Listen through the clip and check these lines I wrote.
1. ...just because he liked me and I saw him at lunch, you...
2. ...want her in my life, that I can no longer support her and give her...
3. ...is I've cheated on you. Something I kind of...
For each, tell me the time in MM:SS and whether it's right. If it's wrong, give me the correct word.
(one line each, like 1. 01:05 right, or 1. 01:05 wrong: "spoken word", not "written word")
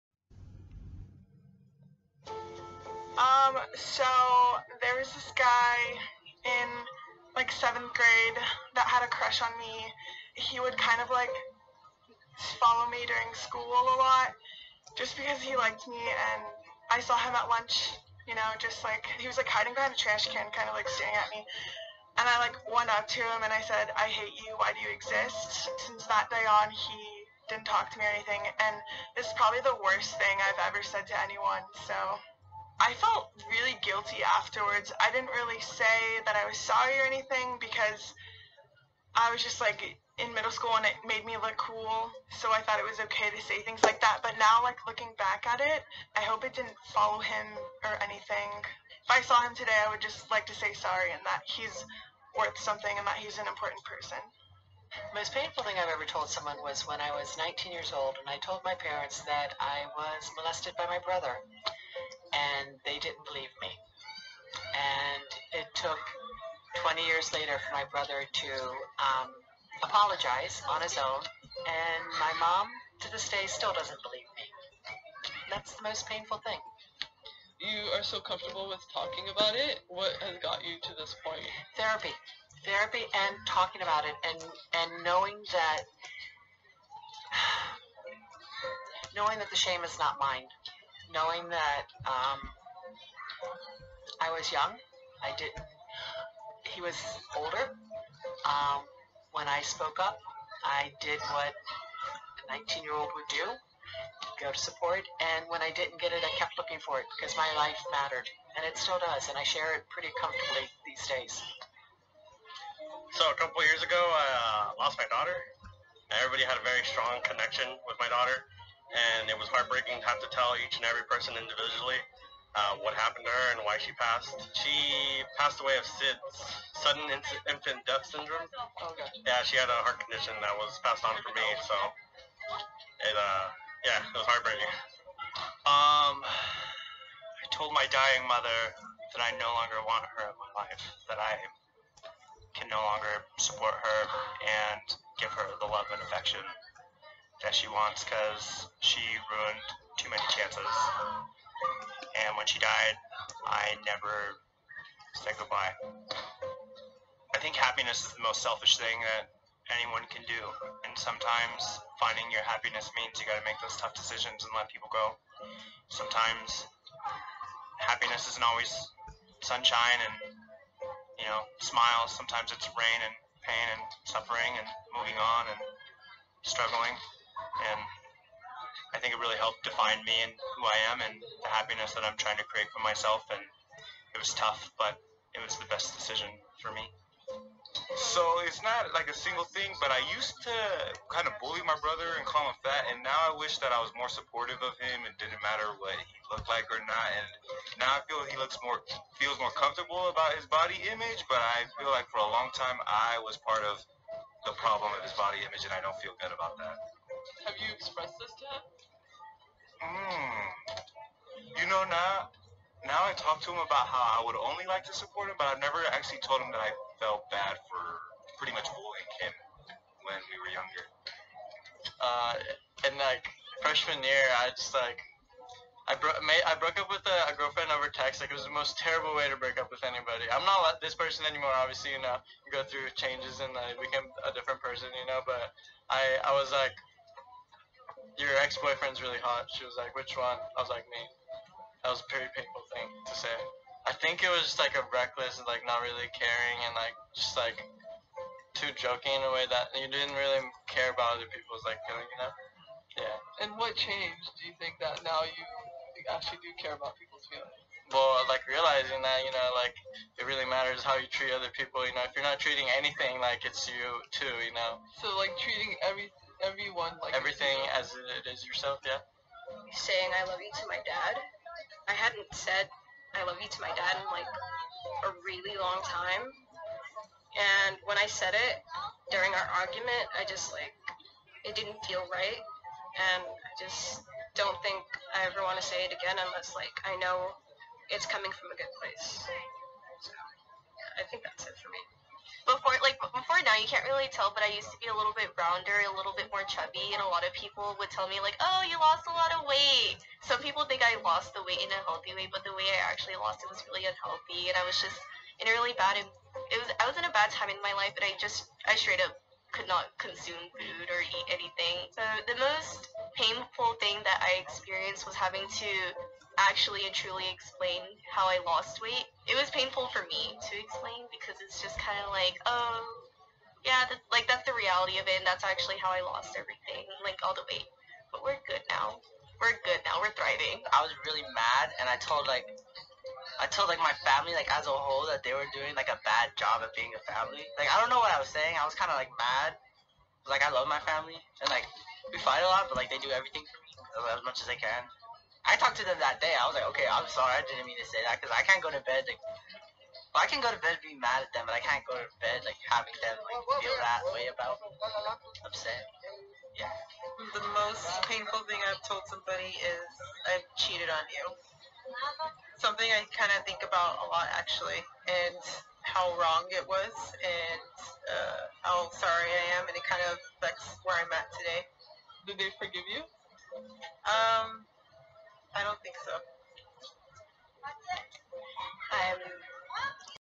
1. 00:14 right
2. 02:19 right
3. 05:59 right.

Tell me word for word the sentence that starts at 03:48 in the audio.
Like it was the most terrible way to break up with anybody.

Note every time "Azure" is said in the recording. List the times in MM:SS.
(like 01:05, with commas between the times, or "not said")
not said.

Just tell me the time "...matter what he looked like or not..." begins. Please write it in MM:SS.
03:15.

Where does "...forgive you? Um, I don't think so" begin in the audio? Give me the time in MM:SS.
06:12.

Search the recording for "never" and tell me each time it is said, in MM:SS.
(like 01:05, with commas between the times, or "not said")
02:33, 03:35.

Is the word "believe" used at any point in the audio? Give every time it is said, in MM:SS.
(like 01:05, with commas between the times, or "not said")
01:03, 01:14.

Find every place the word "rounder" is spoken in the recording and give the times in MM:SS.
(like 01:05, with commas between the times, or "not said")
04:55.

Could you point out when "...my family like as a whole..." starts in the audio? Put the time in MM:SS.
05:33.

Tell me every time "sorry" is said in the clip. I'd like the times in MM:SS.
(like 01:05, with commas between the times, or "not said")
00:36, 00:50, 05:47, 06:08.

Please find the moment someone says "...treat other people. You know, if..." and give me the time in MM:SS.
04:21.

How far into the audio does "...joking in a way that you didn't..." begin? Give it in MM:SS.
04:08.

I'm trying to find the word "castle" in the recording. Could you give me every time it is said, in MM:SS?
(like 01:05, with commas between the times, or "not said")
not said.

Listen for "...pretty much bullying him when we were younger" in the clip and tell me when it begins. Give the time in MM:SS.
03:38.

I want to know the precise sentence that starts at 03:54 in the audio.
You know, but I I was like your ex boyfriend's really hot.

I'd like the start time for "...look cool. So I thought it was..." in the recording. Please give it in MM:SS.
00:41.